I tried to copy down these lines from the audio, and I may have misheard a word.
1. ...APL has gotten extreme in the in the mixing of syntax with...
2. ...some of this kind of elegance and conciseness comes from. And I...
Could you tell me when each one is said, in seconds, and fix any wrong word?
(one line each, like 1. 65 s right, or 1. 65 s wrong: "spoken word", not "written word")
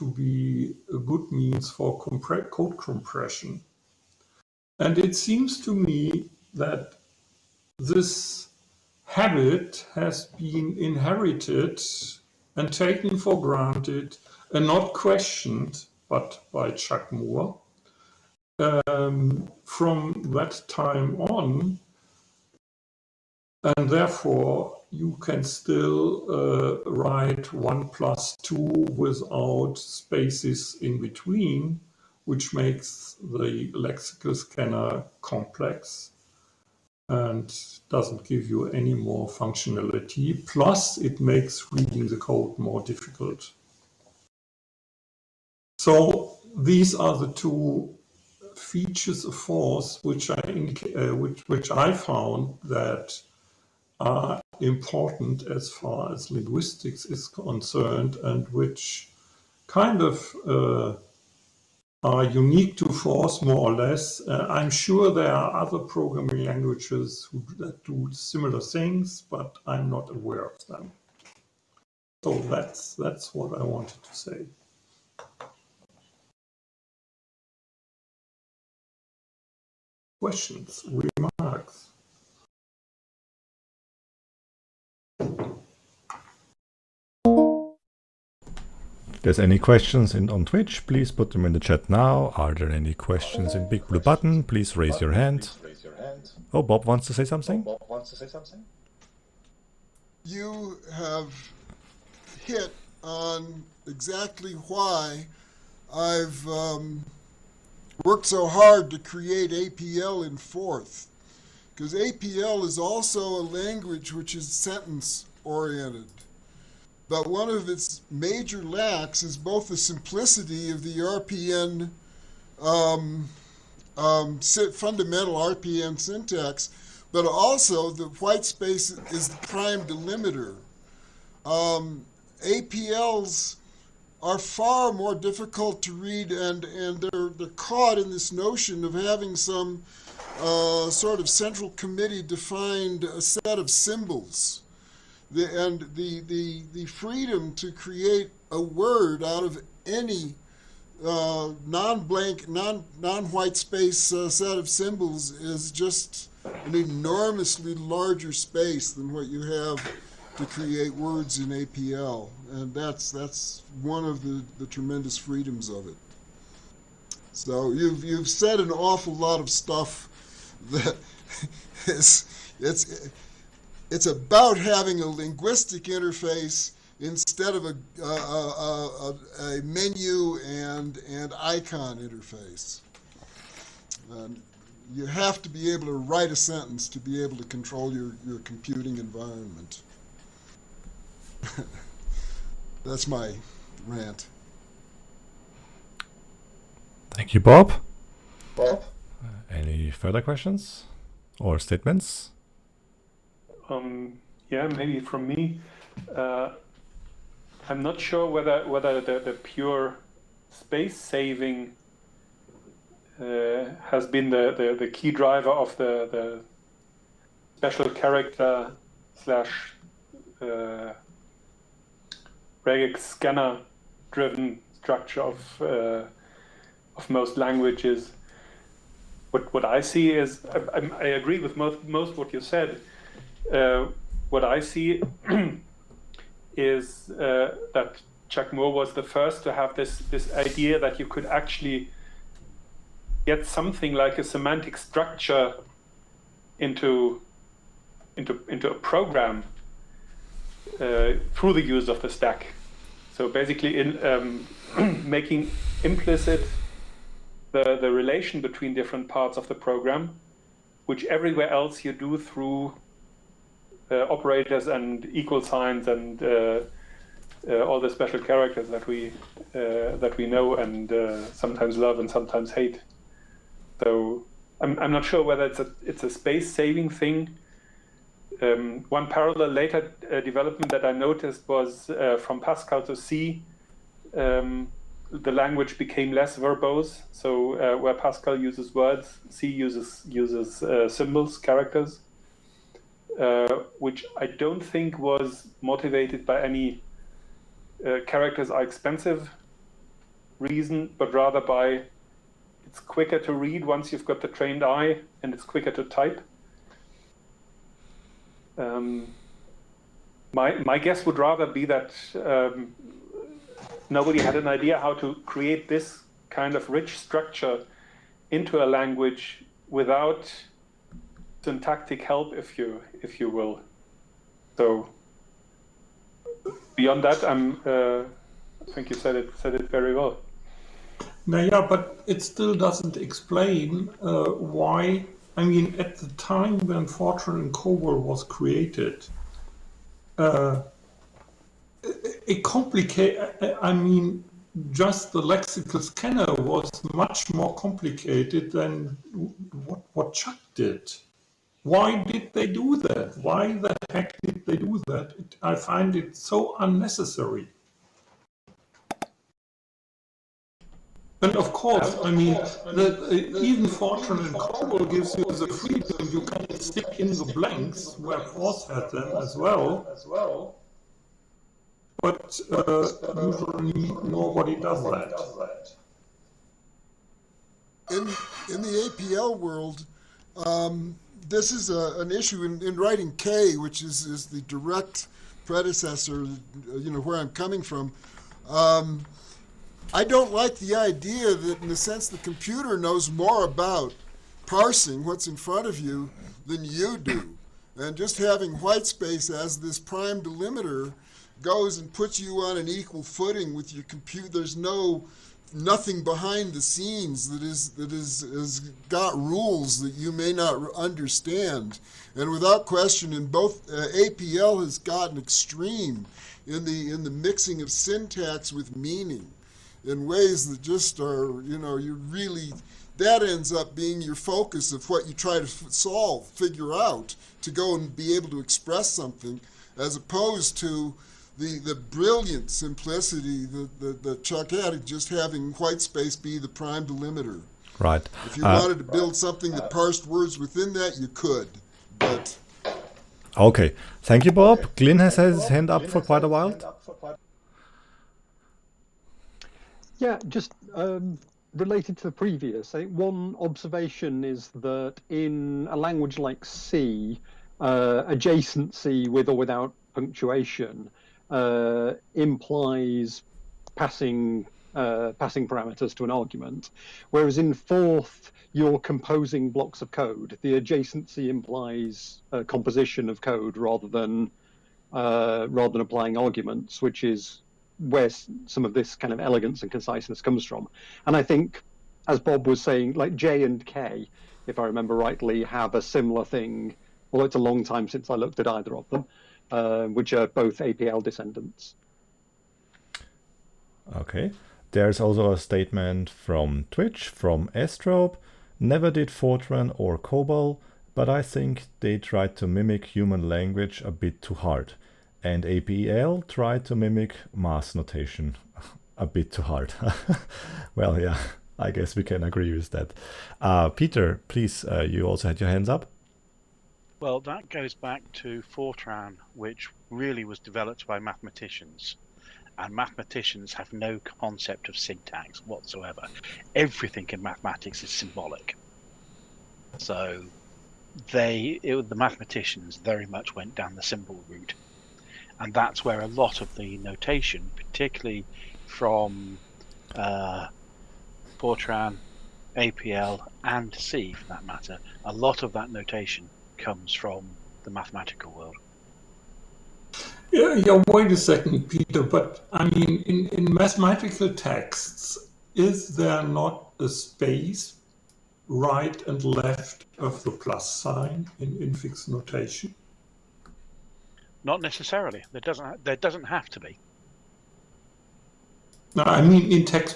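1. 414 s right
2. 478 s right.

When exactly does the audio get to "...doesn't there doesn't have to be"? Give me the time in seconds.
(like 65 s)
565 s.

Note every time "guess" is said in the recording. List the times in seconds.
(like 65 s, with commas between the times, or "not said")
310 s, 511 s.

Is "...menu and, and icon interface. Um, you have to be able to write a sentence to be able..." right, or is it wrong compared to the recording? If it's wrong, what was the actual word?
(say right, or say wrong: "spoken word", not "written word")
right.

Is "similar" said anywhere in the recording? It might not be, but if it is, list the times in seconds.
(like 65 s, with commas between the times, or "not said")
68 s, 485 s.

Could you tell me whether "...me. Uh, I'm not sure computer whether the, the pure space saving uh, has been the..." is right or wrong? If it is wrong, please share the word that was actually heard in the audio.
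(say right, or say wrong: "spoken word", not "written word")
wrong: "whether", not "computer".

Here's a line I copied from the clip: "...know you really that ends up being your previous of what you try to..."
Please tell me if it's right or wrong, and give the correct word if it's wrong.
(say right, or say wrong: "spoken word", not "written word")
wrong: "focus", not "previous".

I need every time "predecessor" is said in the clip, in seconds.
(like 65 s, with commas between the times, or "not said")
385 s.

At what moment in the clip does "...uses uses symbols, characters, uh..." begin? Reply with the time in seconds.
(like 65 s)
289 s.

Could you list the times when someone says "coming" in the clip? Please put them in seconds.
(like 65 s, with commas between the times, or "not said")
387 s.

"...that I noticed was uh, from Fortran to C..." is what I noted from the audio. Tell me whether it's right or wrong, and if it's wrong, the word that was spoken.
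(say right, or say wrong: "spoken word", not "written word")
wrong: "Pascal", not "Fortran".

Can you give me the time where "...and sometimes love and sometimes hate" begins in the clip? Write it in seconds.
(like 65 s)
270 s.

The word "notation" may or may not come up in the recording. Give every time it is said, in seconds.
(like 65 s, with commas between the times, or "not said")
507 s, 536 s, 545 s, 562 s.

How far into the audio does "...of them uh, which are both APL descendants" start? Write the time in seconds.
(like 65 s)
488 s.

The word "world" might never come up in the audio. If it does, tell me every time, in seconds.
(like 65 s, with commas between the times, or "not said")
379 s, 548 s.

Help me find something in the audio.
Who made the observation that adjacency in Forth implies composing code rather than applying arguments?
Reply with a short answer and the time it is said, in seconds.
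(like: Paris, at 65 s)
Glenn, at 444 s.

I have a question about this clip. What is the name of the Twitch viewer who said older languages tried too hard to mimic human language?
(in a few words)
Estrope.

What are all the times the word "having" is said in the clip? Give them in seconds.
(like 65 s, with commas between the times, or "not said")
138 s, 174 s, 398 s, 435 s.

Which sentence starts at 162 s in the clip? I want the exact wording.
And that's, that's one of the, the tremendous freedoms of it.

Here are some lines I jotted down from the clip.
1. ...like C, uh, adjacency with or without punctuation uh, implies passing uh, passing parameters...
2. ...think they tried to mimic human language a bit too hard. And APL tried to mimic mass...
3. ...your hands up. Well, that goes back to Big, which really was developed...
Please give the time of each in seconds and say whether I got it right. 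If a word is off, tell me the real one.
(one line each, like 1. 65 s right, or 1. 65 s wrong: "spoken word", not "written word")
1. 456 s right
2. 501 s right
3. 515 s wrong: "Fortran", not "Big".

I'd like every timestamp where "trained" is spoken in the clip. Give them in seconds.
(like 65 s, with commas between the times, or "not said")
304 s.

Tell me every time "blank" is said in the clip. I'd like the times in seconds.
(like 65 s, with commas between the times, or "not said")
151 s, 367 s.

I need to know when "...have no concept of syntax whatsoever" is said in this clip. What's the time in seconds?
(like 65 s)
523 s.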